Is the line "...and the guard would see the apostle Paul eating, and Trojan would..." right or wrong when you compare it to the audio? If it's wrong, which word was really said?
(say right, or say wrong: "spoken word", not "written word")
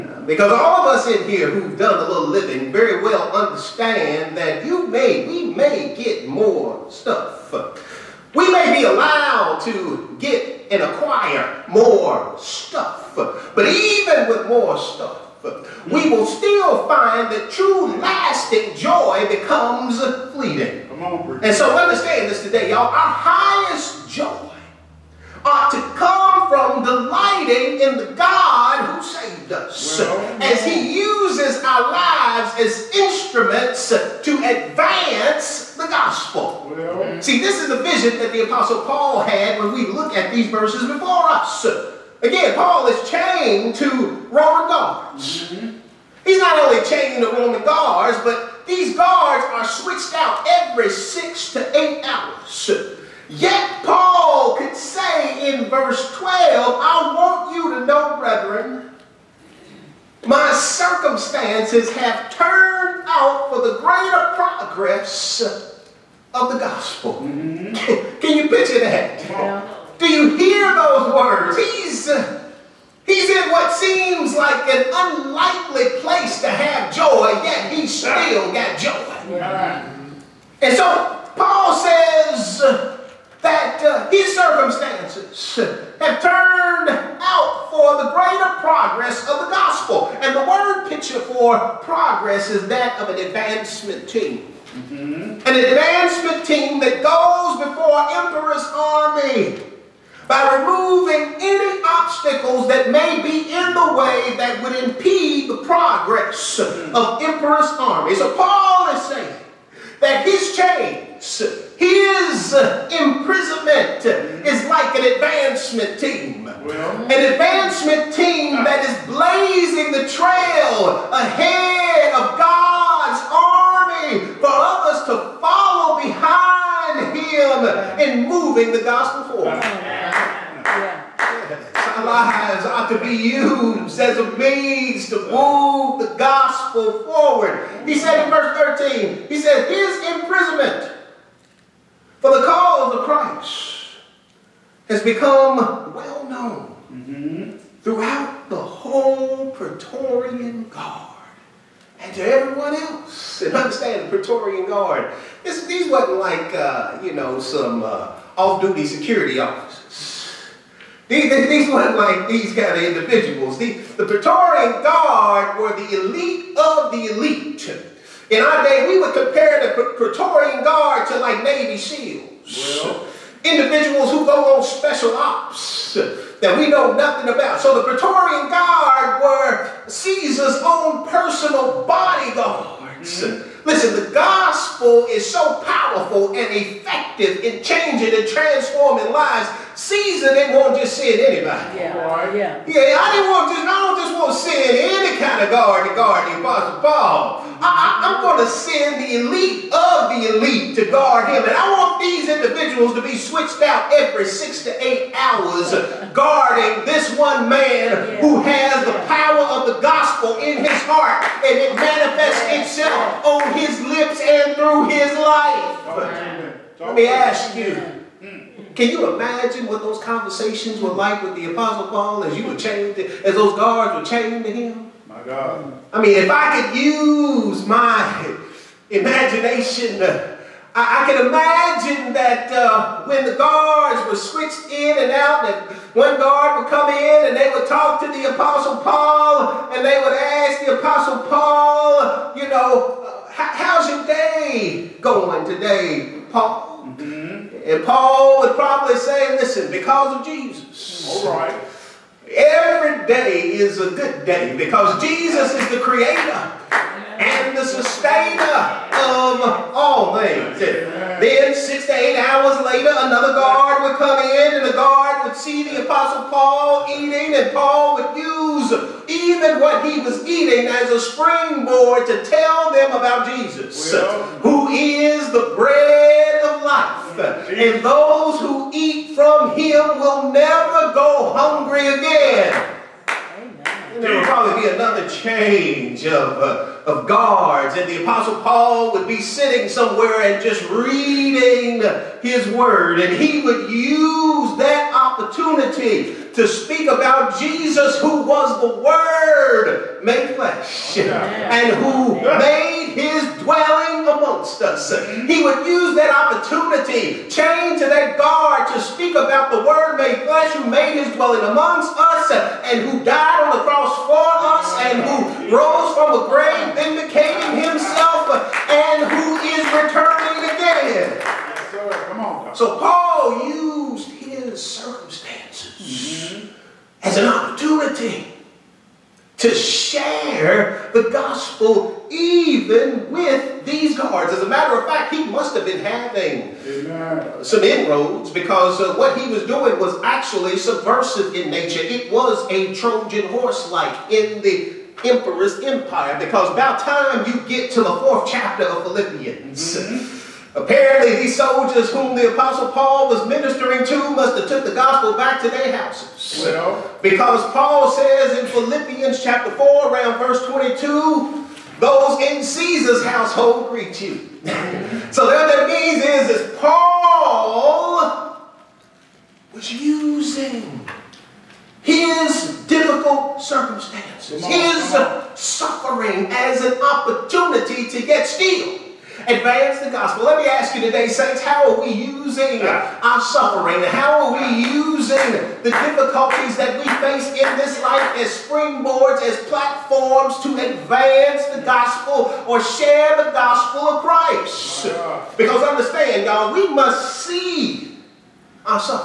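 wrong: "Paul", not "Trojan".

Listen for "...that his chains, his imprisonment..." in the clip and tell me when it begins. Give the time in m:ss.
1:50.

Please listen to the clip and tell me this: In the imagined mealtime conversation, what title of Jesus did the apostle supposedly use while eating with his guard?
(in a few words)
bread of life.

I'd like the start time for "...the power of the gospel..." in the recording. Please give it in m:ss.
3:28.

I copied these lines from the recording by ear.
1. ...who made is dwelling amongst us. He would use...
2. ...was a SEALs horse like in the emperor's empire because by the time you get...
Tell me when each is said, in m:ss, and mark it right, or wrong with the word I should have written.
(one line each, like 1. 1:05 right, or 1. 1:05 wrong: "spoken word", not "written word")
1. 5:01 right
2. 5:42 wrong: "Trojan", not "SEALs".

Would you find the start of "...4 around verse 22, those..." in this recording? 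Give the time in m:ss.
5:59.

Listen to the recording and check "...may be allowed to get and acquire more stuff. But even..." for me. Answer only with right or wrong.
right.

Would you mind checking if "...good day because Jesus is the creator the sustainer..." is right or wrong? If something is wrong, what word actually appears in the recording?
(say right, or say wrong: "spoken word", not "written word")
right.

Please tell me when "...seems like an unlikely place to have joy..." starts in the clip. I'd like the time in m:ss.
1:13.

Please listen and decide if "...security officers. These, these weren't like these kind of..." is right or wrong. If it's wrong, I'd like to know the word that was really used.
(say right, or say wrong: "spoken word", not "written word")
right.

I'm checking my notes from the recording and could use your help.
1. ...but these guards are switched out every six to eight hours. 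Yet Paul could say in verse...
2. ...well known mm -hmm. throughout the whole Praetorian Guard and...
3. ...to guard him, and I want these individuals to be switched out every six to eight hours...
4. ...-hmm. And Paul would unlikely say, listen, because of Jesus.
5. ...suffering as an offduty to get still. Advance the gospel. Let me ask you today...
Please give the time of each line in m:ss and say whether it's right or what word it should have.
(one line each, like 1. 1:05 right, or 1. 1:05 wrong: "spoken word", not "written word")
1. 0:48 right
2. 2:25 right
3. 3:20 right
4. 4:07 wrong: "probably", not "unlikely"
5. 6:15 wrong: "opportunity", not "offduty".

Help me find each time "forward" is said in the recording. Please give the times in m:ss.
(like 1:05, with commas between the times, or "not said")
2:09, 2:17.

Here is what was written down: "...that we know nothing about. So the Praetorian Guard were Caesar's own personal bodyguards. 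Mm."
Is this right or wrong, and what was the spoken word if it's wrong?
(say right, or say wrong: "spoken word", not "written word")
right.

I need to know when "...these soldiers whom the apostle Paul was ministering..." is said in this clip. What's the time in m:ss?
5:51.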